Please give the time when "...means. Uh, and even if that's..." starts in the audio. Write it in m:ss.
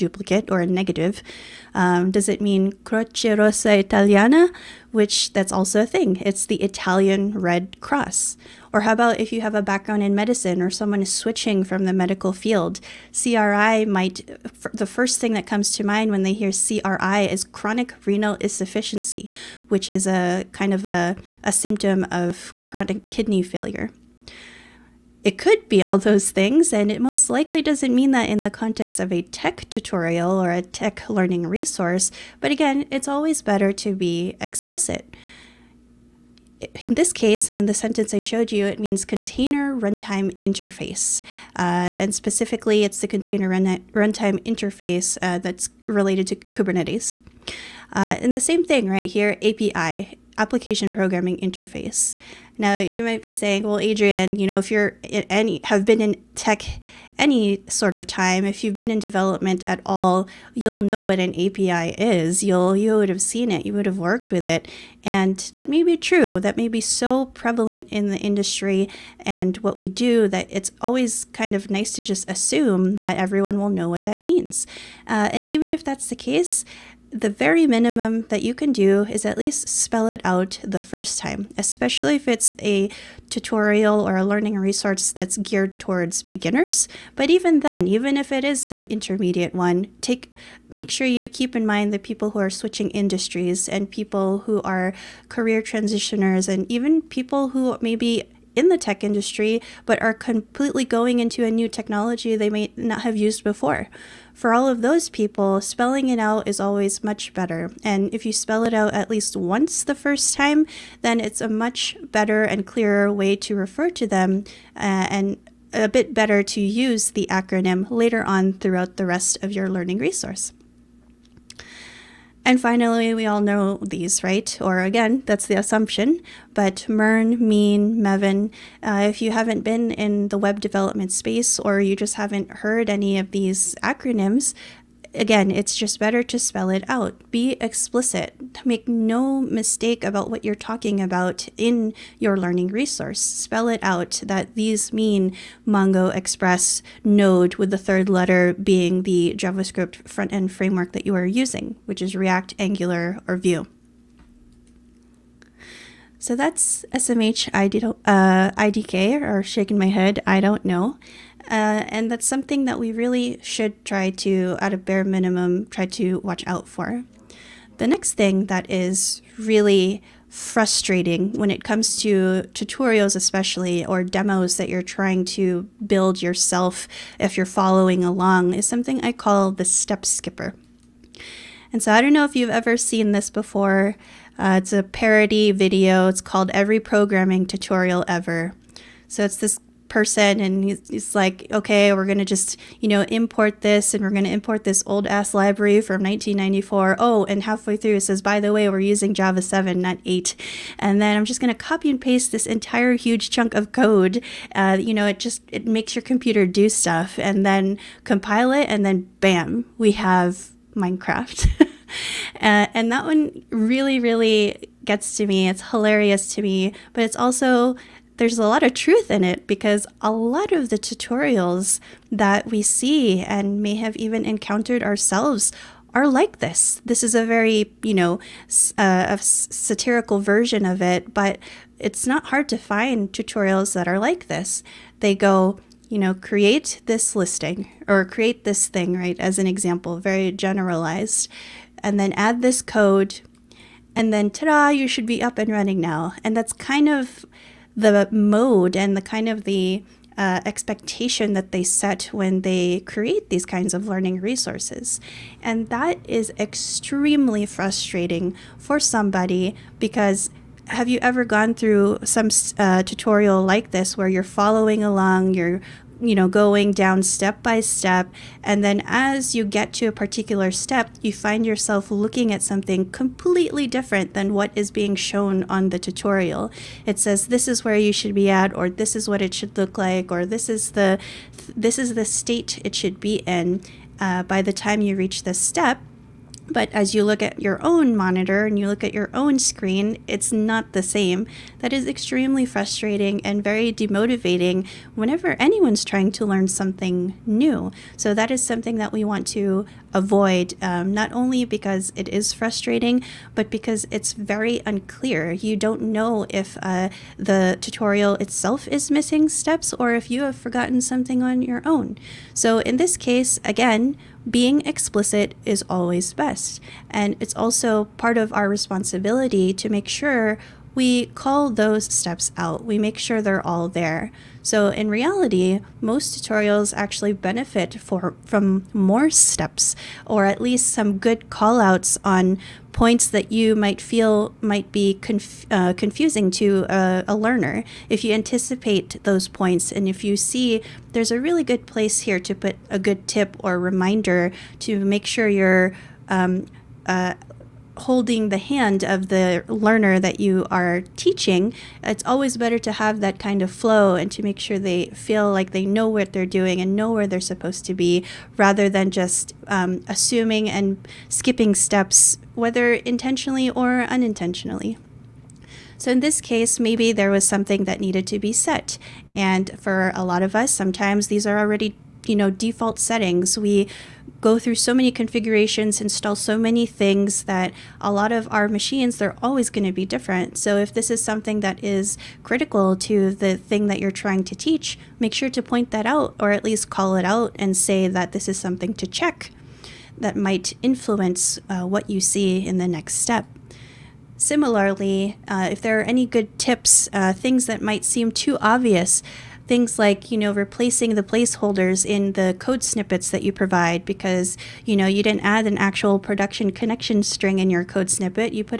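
1:14.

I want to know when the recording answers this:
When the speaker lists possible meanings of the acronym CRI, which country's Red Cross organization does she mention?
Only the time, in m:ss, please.
0:06.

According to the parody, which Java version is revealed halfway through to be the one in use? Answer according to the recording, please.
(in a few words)
Java 7.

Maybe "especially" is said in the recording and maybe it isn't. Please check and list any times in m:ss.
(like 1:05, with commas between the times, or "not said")
1:21, 2:53.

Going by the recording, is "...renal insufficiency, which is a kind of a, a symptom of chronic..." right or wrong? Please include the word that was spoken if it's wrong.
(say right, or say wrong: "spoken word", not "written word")
right.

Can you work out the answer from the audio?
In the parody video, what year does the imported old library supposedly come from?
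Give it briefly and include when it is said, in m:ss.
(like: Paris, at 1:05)
1994, at 3:16.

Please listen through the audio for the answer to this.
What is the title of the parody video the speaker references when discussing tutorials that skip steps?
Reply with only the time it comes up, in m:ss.
3:06.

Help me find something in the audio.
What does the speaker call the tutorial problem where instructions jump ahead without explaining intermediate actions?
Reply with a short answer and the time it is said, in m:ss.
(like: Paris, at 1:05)
the step skipper, at 2:59.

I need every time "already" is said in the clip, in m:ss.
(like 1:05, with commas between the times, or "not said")
6:11.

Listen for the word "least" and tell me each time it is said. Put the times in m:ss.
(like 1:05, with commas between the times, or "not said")
1:19, 1:49, 5:30, 6:26.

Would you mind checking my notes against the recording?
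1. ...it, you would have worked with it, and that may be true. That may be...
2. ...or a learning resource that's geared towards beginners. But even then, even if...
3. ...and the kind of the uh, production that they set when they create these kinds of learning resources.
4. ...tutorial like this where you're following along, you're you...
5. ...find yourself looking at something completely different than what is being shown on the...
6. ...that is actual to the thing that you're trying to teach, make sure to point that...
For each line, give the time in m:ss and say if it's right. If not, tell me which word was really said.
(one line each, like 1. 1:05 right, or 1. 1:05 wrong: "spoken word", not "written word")
1. 1:03 right
2. 1:24 right
3. 4:08 wrong: "expectation", not "production"
4. 4:22 right
5. 4:31 right
6. 6:21 wrong: "critical", not "actual".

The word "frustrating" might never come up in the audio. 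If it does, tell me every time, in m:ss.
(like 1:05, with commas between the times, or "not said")
2:50, 4:17, 4:52, 5:02.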